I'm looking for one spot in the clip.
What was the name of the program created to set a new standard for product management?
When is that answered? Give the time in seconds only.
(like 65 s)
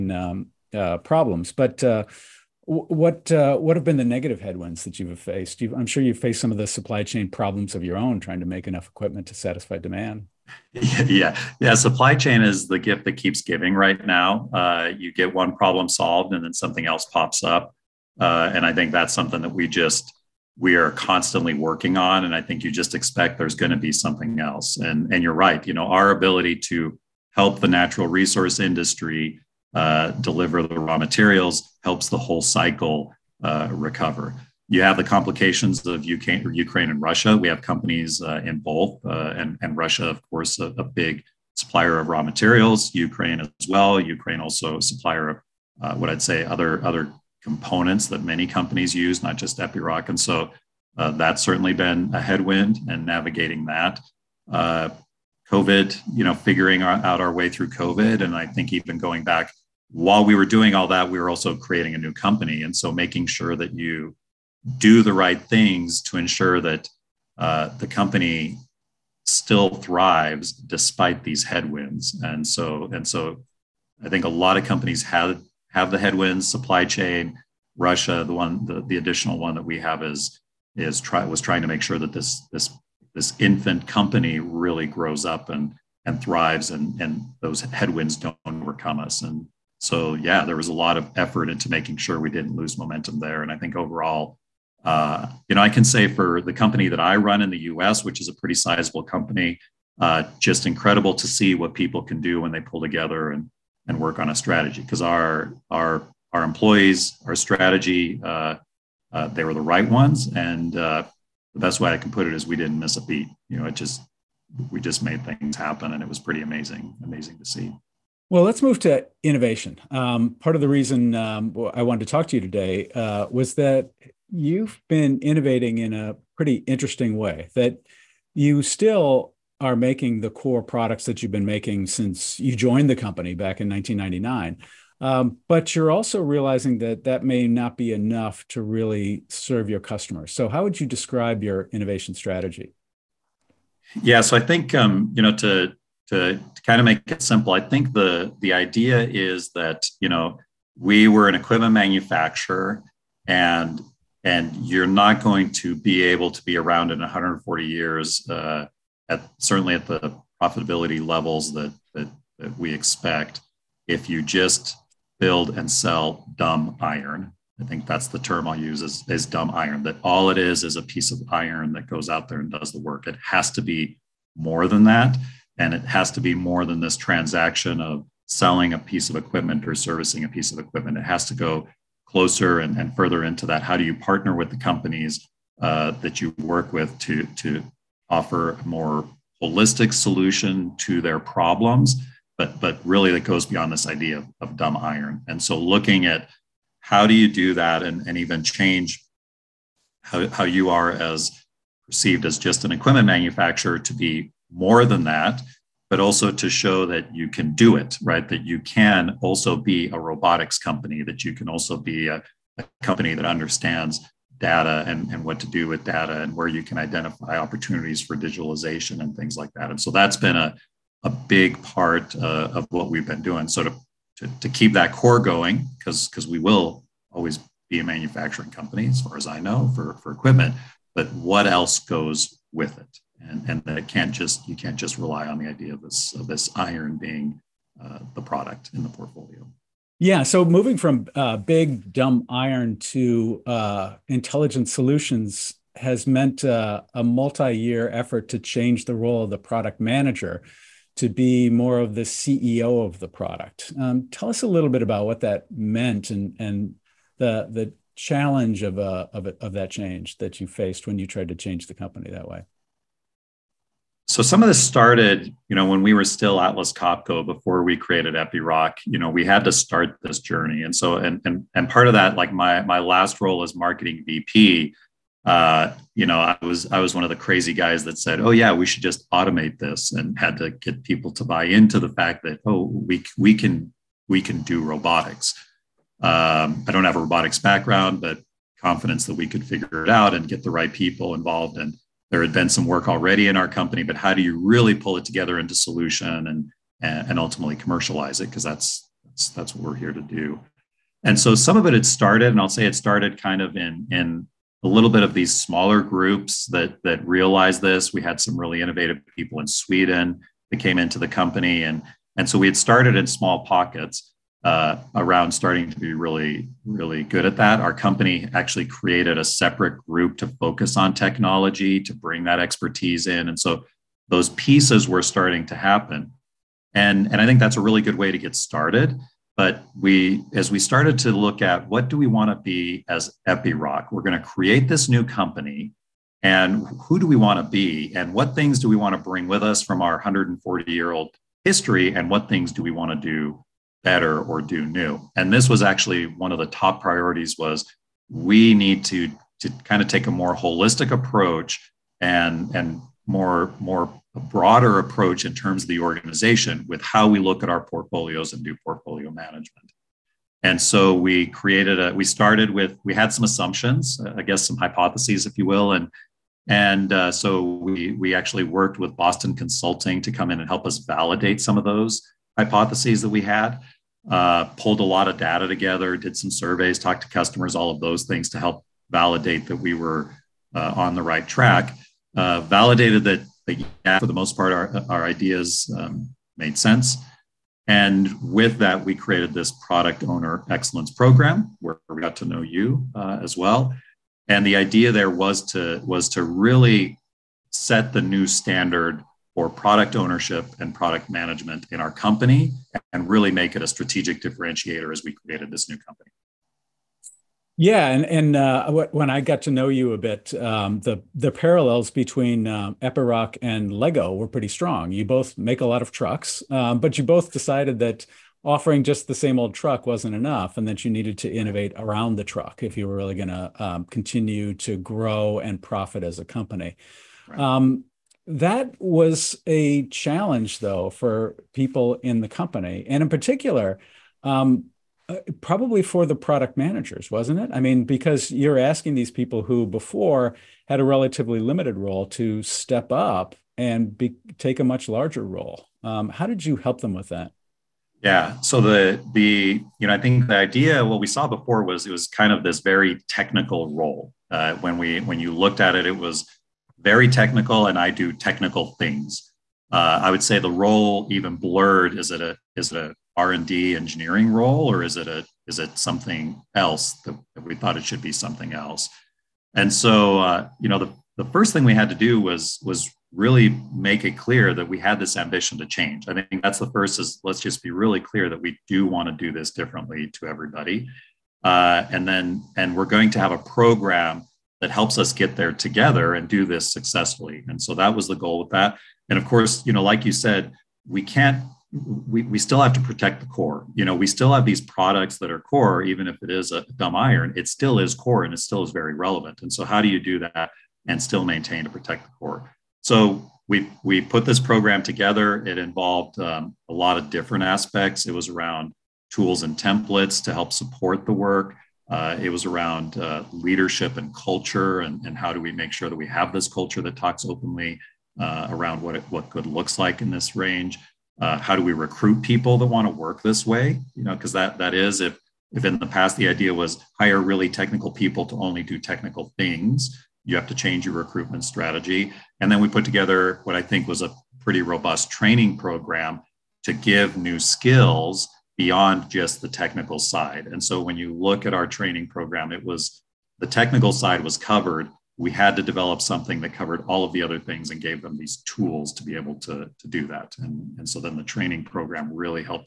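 389 s.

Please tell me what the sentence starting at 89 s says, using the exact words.
And so yeah, there was a lot of effort into making sure we didn't lose momentum there.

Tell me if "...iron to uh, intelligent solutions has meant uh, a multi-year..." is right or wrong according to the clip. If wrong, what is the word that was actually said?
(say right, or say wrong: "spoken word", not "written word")
right.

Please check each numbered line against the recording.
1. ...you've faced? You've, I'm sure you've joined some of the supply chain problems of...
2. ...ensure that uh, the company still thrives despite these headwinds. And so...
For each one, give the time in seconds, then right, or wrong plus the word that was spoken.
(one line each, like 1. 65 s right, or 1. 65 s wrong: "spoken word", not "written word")
1. 4 s wrong: "faced", not "joined"
2. 66 s right.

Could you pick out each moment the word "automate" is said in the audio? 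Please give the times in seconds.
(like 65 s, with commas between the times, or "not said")
279 s.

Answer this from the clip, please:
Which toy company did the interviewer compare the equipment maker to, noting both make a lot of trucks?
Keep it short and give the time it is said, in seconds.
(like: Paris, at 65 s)
Lego, at 413 s.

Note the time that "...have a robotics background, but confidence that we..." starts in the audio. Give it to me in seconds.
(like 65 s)
286 s.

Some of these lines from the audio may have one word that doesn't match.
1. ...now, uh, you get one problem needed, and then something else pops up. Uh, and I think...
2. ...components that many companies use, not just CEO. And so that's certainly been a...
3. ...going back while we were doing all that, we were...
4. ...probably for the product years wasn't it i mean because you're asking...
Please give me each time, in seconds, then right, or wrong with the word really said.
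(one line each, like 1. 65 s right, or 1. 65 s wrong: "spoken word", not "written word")
1. 14 s wrong: "solved", not "needed"
2. 47 s wrong: "Epiroc", not "CEO"
3. 58 s right
4. 435 s wrong: "managers", not "years".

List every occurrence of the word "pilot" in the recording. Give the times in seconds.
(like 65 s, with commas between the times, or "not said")
not said.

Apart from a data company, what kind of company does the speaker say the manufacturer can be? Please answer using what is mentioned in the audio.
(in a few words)
a robotics company.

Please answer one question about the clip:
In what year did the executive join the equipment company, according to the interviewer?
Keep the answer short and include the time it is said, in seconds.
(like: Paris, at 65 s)
1999, at 133 s.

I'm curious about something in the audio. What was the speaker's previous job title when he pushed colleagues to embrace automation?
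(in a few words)
marketing VP.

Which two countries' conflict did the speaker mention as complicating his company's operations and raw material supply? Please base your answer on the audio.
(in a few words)
Ukraine and Russia.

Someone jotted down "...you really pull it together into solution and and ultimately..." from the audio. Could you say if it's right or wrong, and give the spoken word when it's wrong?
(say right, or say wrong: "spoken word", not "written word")
right.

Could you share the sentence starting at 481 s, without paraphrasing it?
Uh, and then and we're going to have a program that helps us get there together and do this successfully.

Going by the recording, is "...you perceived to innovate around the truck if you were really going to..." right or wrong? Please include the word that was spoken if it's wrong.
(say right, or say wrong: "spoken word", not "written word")
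wrong: "needed", not "perceived".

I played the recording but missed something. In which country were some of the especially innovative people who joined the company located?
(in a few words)
Sweden.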